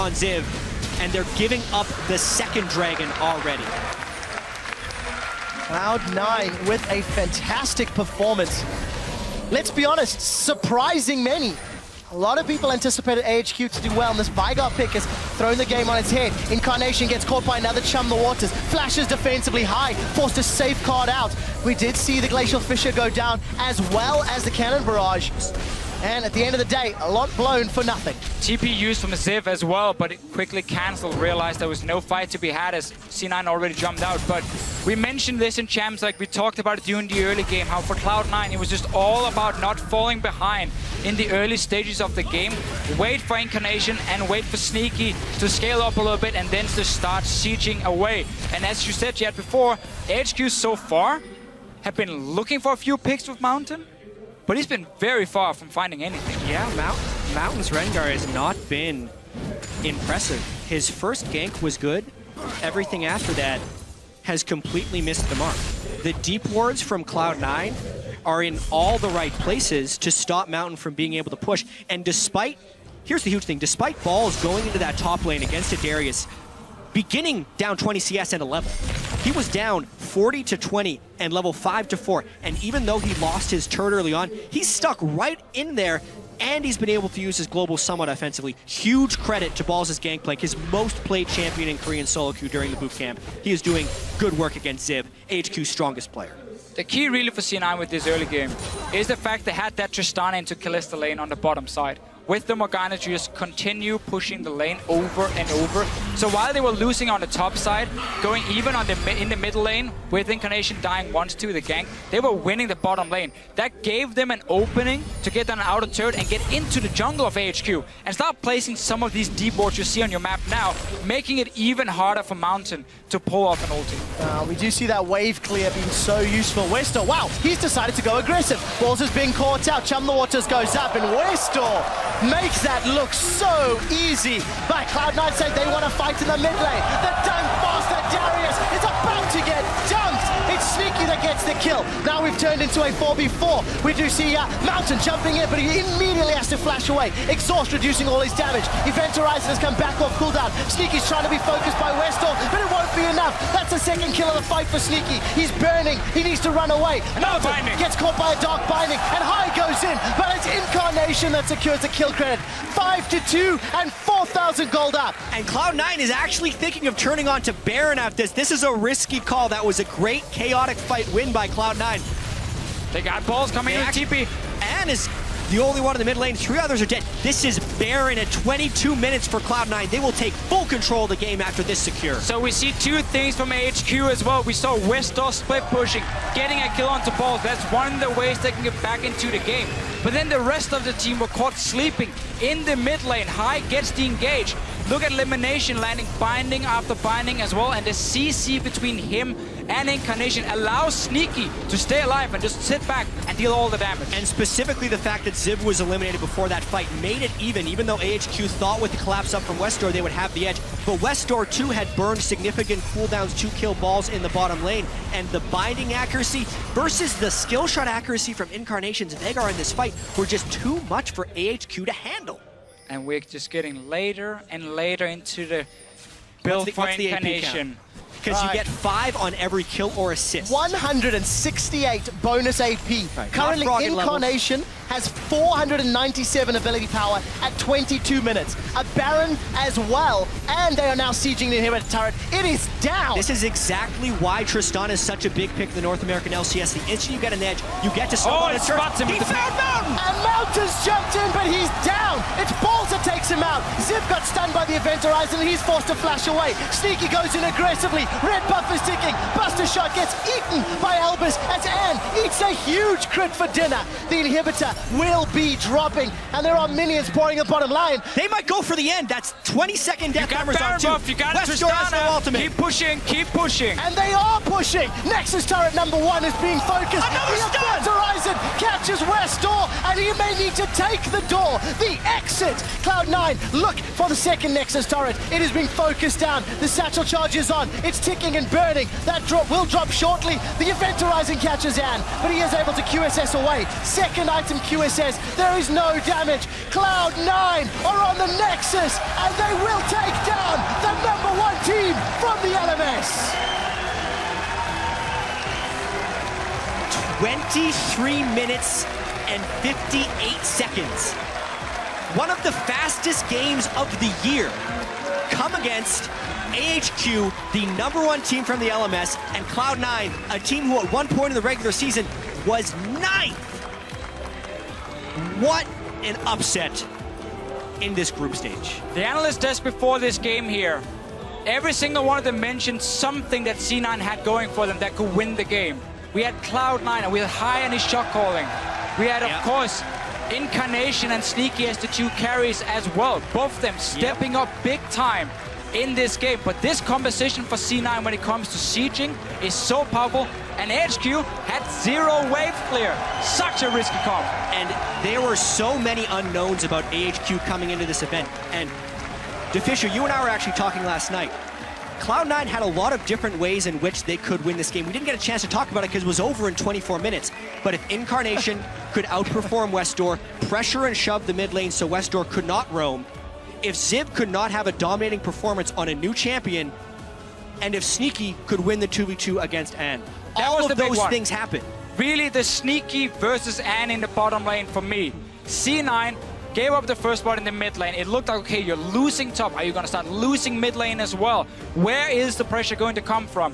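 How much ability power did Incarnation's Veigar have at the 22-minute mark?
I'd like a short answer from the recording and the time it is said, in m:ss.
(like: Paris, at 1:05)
497, at 3:55.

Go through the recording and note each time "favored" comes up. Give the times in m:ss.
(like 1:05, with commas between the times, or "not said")
not said.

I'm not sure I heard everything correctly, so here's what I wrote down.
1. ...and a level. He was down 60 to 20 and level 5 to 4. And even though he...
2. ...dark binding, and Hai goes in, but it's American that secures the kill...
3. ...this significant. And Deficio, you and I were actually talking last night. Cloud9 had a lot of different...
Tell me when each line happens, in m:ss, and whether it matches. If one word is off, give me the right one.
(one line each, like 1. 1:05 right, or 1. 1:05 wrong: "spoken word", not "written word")
1. 1:18 wrong: "40", not "60"
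2. 2:38 wrong: "Incarnation", not "American"
3. 5:57 wrong: "event", not "significant".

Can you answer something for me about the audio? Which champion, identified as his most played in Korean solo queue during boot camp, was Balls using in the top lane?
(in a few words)
Gangplank.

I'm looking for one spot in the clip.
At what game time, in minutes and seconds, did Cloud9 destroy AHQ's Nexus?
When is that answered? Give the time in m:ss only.
5:07.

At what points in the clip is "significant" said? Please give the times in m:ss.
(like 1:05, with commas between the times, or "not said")
3:32.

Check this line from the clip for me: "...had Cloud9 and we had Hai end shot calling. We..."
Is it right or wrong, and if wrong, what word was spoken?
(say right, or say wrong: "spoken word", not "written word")
right.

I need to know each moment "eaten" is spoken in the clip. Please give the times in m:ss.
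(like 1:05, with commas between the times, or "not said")
4:20.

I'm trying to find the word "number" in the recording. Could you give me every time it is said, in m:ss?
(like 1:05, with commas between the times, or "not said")
4:35, 5:01, 5:17.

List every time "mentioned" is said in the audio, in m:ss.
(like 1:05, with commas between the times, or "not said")
0:34, 5:32.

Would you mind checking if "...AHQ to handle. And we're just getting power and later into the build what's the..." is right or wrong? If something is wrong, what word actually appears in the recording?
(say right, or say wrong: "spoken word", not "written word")
wrong: "later", not "power".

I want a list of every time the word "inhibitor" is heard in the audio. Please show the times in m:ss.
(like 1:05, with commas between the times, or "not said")
4:01, 4:24.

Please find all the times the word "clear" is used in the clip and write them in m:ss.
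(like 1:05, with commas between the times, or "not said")
2:05, 5:52.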